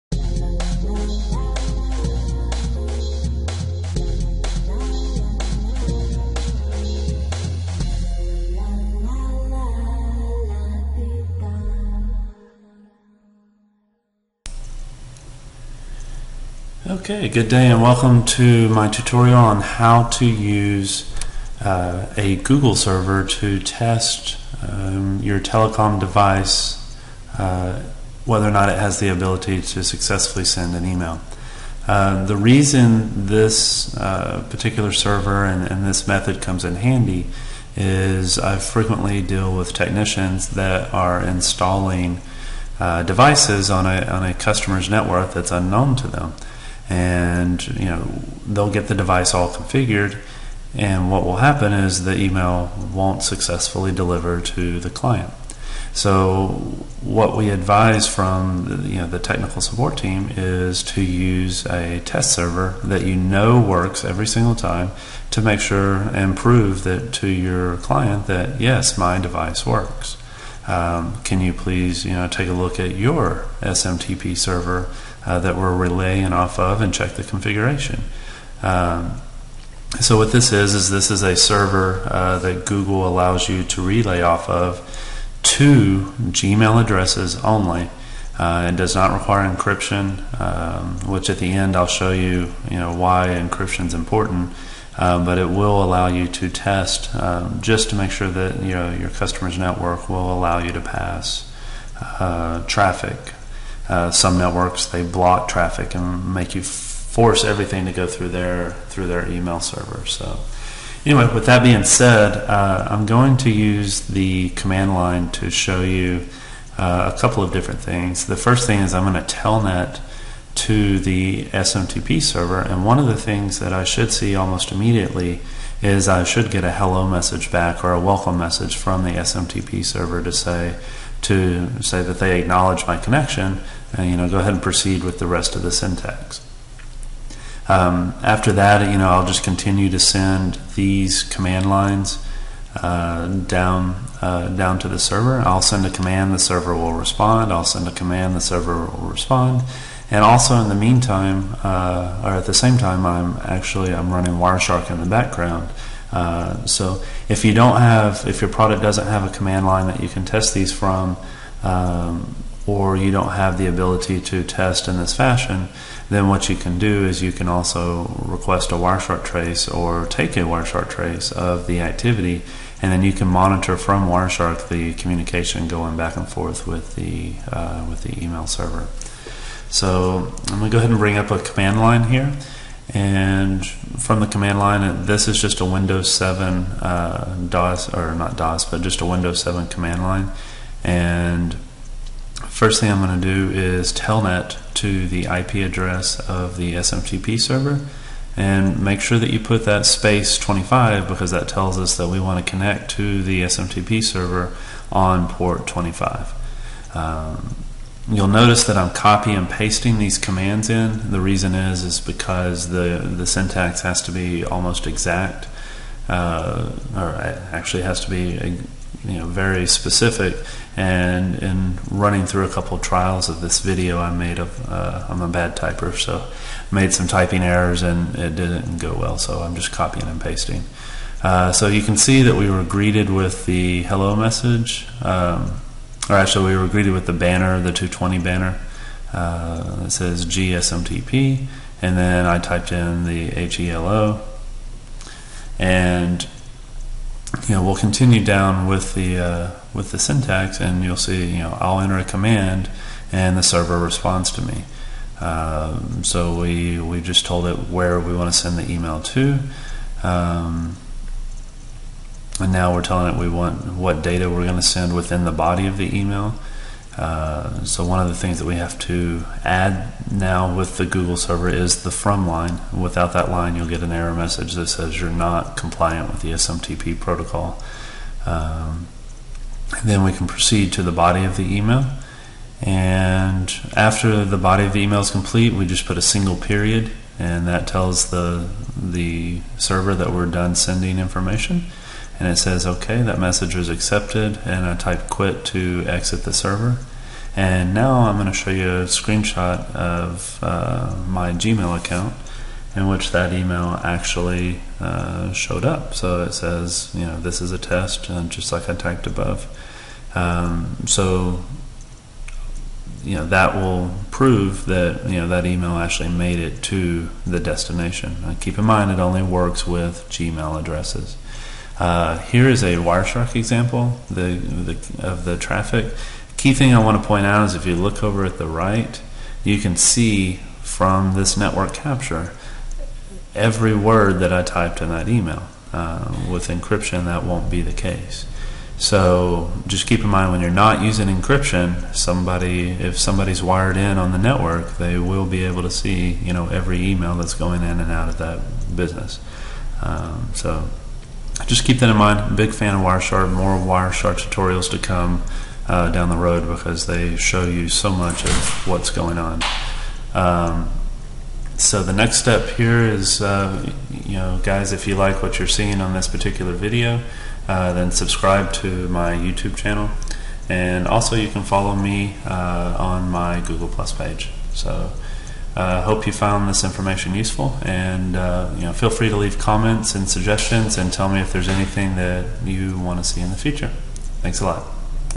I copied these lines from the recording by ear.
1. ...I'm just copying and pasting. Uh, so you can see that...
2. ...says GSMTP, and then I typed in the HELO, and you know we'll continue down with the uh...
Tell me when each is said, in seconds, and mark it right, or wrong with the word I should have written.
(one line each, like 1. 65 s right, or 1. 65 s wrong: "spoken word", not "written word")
1. 229 s right
2. 239 s right.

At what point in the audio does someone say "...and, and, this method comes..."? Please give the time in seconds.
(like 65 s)
35 s.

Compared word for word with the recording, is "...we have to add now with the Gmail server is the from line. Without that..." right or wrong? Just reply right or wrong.
wrong.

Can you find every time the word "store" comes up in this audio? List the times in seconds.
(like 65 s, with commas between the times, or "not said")
not said.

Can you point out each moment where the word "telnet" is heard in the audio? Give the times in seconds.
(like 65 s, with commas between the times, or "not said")
119 s, 193 s.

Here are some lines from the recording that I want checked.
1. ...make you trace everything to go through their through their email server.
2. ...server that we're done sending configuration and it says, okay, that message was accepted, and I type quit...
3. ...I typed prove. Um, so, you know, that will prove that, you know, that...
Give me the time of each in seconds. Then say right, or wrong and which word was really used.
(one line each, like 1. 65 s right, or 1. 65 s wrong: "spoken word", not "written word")
1. 106 s wrong: "force", not "trace"
2. 289 s wrong: "information", not "configuration"
3. 308 s wrong: "above", not "prove".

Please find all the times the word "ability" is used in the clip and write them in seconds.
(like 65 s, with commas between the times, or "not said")
29 s, 163 s.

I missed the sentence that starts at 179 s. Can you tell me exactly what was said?
So I'm going to go ahead and bring up a command line here.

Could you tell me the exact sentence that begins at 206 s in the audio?
Um, You'll notice that I'm copy and pasting these commands in.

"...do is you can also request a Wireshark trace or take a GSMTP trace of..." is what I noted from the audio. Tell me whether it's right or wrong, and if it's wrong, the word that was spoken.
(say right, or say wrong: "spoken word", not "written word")
wrong: "Wireshark", not "GSMTP".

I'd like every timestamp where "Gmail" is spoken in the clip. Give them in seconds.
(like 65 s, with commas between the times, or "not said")
86 s, 301 s, 320 s.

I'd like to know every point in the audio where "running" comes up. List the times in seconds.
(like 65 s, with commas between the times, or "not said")
154 s, 221 s.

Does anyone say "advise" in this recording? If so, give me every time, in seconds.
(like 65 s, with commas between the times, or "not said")
57 s.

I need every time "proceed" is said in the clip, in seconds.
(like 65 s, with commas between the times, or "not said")
134 s, 280 s.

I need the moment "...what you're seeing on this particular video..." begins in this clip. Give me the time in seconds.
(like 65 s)
365 s.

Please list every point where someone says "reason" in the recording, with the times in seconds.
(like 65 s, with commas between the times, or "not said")
32 s, 211 s.